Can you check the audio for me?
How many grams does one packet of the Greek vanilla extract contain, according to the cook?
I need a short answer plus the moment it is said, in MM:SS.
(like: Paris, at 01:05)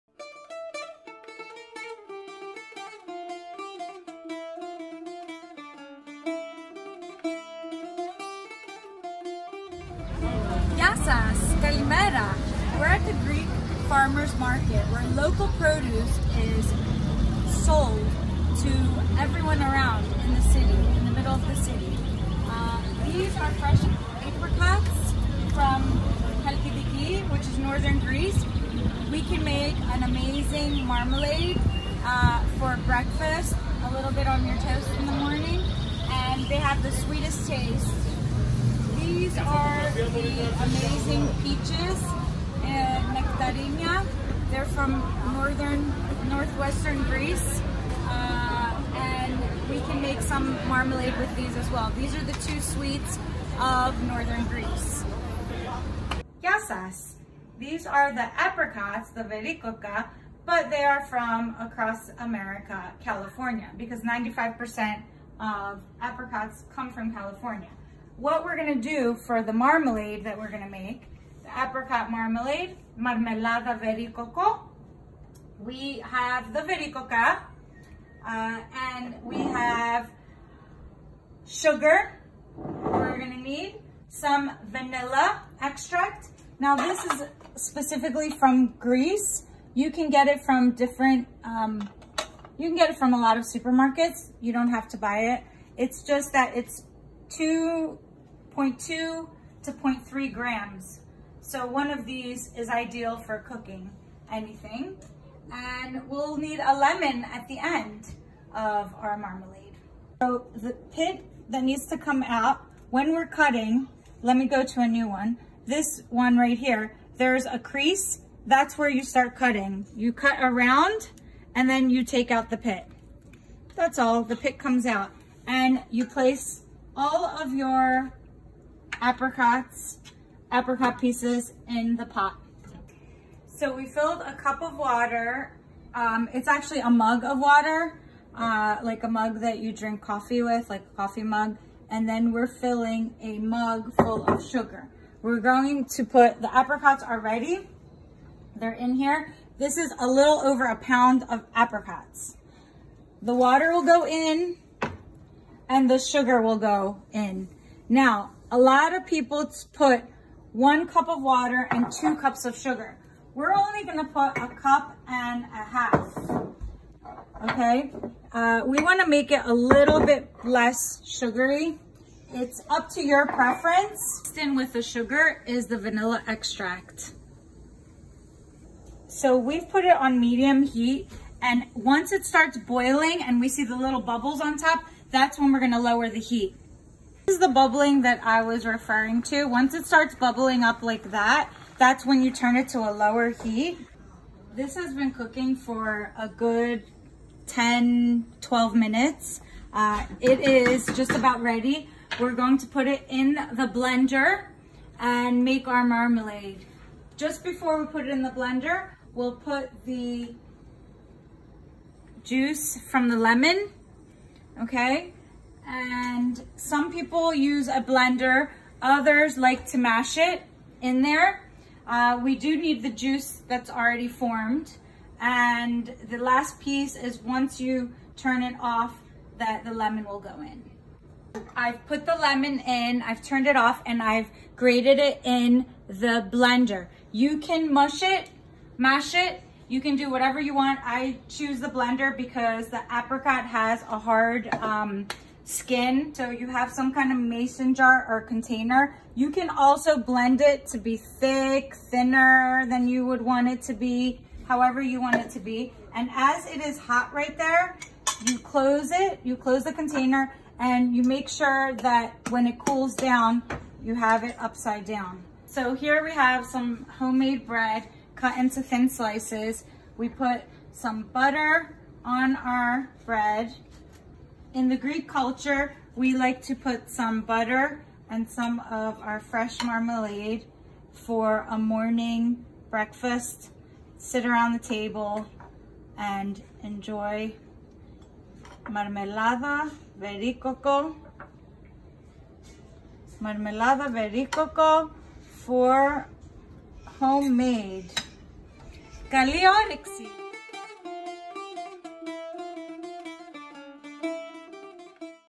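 0.2 to 0.3 grams, at 01:38.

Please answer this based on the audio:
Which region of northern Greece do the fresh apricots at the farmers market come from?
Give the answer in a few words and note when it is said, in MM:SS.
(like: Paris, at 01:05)
Halkidiki, at 00:26.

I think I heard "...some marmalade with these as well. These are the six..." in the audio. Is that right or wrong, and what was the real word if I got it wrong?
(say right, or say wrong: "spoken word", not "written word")
wrong: "two", not "six".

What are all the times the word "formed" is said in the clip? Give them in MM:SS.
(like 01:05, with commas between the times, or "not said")
03:44.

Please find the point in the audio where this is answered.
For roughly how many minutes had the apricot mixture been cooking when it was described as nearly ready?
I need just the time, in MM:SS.
03:17.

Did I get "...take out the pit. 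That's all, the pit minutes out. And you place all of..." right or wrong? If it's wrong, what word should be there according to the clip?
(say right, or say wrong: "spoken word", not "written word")
wrong: "comes", not "minutes".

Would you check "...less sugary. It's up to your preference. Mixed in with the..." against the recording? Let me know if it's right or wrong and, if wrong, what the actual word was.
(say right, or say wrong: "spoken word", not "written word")
right.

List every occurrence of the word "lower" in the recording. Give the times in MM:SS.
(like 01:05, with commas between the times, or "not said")
03:05, 03:12.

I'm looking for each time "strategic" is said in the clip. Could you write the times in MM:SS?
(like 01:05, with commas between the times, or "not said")
not said.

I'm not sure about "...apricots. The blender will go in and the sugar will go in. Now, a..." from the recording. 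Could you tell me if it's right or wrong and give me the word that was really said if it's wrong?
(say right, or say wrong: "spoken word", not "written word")
wrong: "water", not "blender".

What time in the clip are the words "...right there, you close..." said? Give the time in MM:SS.
04:17.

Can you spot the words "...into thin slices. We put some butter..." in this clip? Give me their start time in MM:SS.
04:28.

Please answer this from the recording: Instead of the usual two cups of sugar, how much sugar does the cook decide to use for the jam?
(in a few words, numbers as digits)
a cup and a half.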